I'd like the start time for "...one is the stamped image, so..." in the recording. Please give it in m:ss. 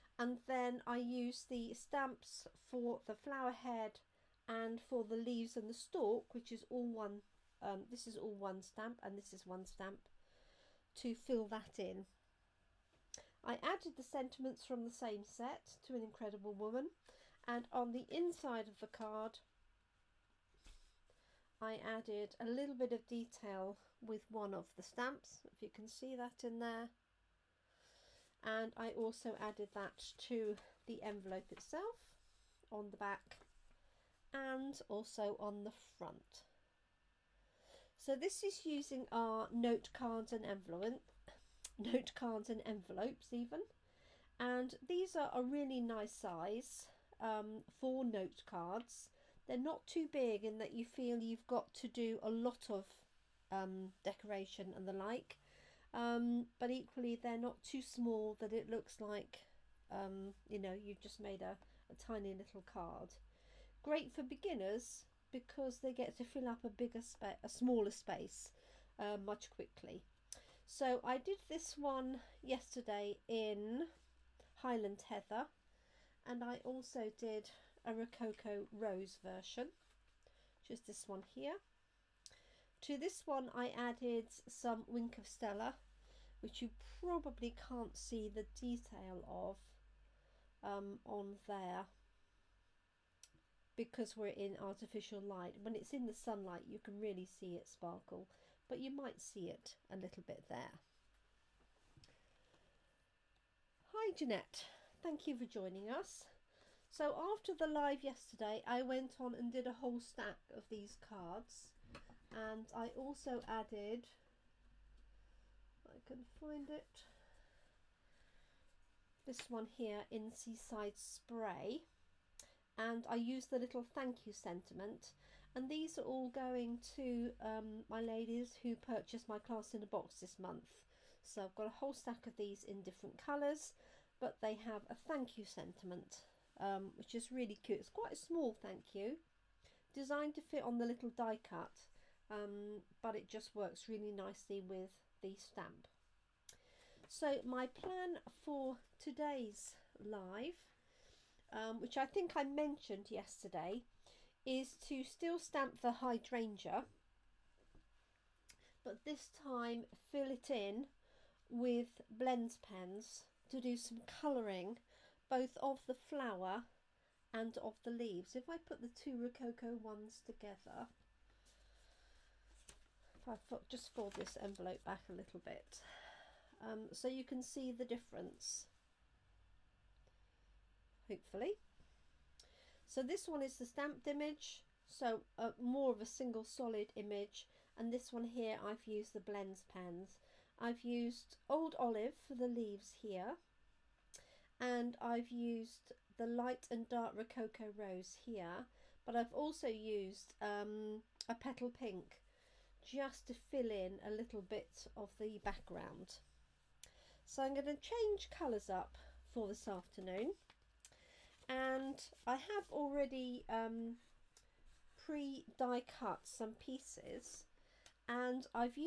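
3:03.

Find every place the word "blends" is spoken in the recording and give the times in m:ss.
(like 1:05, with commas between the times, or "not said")
2:42, 3:09.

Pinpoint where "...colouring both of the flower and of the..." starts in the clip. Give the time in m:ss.
2:44.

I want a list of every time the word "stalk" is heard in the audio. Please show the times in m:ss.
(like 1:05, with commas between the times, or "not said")
0:05.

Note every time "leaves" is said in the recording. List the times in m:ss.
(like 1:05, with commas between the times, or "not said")
0:05, 2:47, 3:12.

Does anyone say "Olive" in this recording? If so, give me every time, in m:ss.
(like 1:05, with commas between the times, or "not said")
3:11.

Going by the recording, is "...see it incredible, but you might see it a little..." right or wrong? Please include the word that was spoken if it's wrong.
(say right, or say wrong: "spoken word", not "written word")
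wrong: "sparkle", not "incredible".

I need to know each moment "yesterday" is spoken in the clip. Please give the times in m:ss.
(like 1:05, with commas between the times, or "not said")
1:12, 1:48, 2:33.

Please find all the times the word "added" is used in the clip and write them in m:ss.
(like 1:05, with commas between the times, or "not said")
0:13, 0:21, 0:29, 1:23, 1:53.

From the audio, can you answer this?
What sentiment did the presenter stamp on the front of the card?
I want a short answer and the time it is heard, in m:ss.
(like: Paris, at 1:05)
To an incredible woman, at 0:15.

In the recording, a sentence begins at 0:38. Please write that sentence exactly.
So this is using our note cards and envelope, note cards and envelopes even.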